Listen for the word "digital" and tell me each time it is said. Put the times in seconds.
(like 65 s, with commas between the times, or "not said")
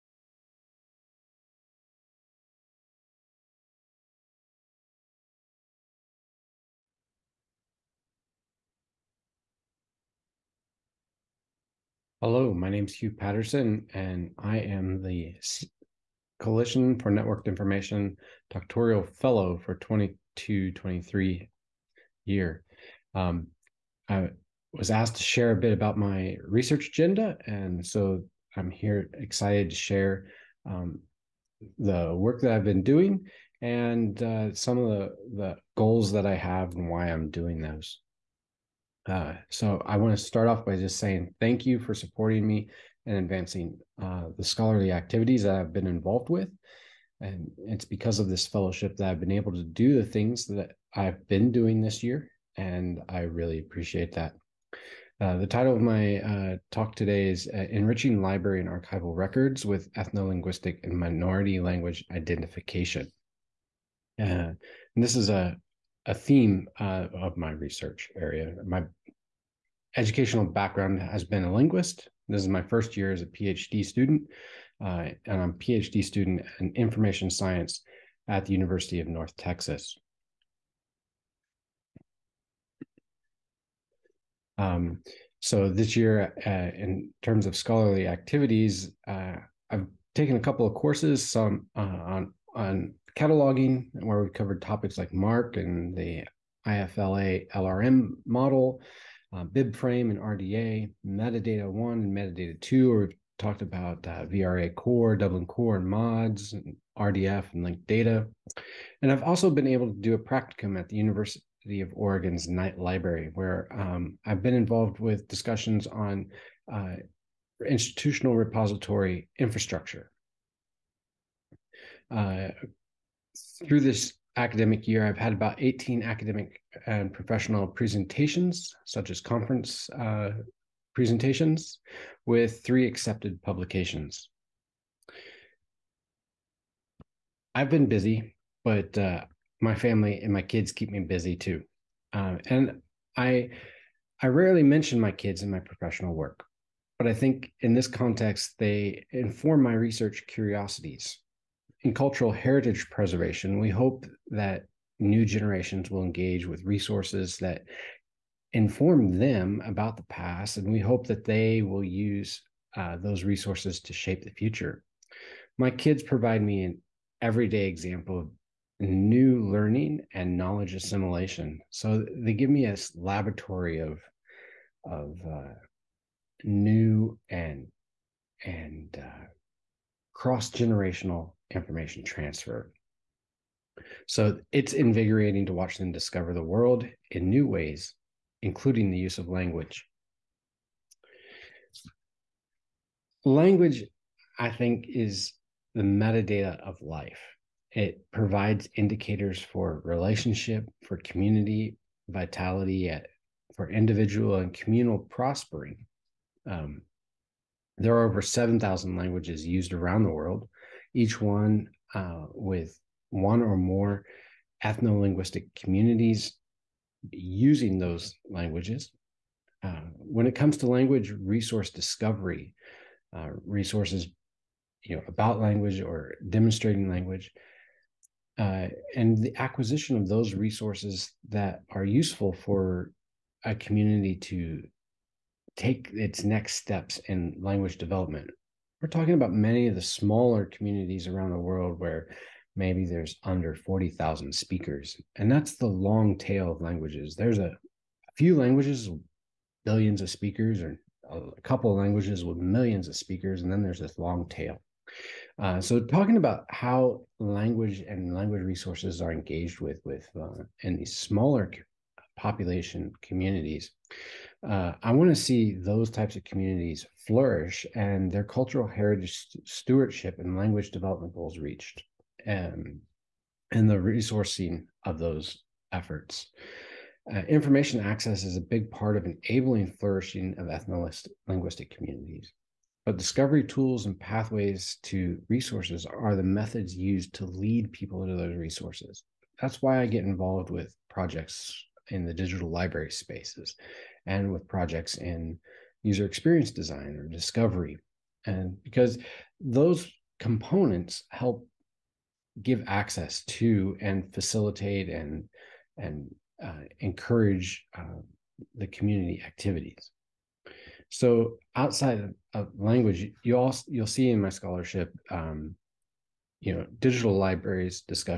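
292 s, 316 s.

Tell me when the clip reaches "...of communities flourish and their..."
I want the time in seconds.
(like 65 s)
266 s.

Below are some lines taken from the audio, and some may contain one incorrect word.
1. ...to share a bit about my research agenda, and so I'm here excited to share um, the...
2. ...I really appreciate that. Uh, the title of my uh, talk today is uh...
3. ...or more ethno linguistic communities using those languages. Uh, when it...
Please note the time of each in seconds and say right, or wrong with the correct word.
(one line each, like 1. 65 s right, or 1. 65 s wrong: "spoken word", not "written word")
1. 25 s right
2. 53 s right
3. 213 s right.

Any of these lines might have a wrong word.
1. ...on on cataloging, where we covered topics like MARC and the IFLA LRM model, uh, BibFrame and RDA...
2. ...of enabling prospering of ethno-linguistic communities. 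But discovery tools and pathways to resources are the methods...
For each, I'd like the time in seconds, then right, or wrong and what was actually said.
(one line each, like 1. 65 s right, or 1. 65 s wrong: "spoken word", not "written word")
1. 91 s right
2. 278 s wrong: "flourishing", not "prospering".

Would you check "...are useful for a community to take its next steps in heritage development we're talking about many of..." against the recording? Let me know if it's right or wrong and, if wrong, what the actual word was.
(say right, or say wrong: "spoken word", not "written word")
wrong: "language", not "heritage".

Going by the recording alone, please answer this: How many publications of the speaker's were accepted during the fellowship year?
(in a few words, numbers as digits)
3.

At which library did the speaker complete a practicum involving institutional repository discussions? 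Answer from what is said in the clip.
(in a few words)
Knight Library.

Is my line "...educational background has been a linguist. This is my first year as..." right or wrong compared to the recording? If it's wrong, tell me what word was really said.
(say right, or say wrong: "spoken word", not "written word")
right.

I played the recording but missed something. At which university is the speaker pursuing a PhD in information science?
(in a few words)
University of North Texas.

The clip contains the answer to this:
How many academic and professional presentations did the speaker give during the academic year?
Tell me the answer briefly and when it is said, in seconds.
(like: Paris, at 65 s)
18, at 125 s.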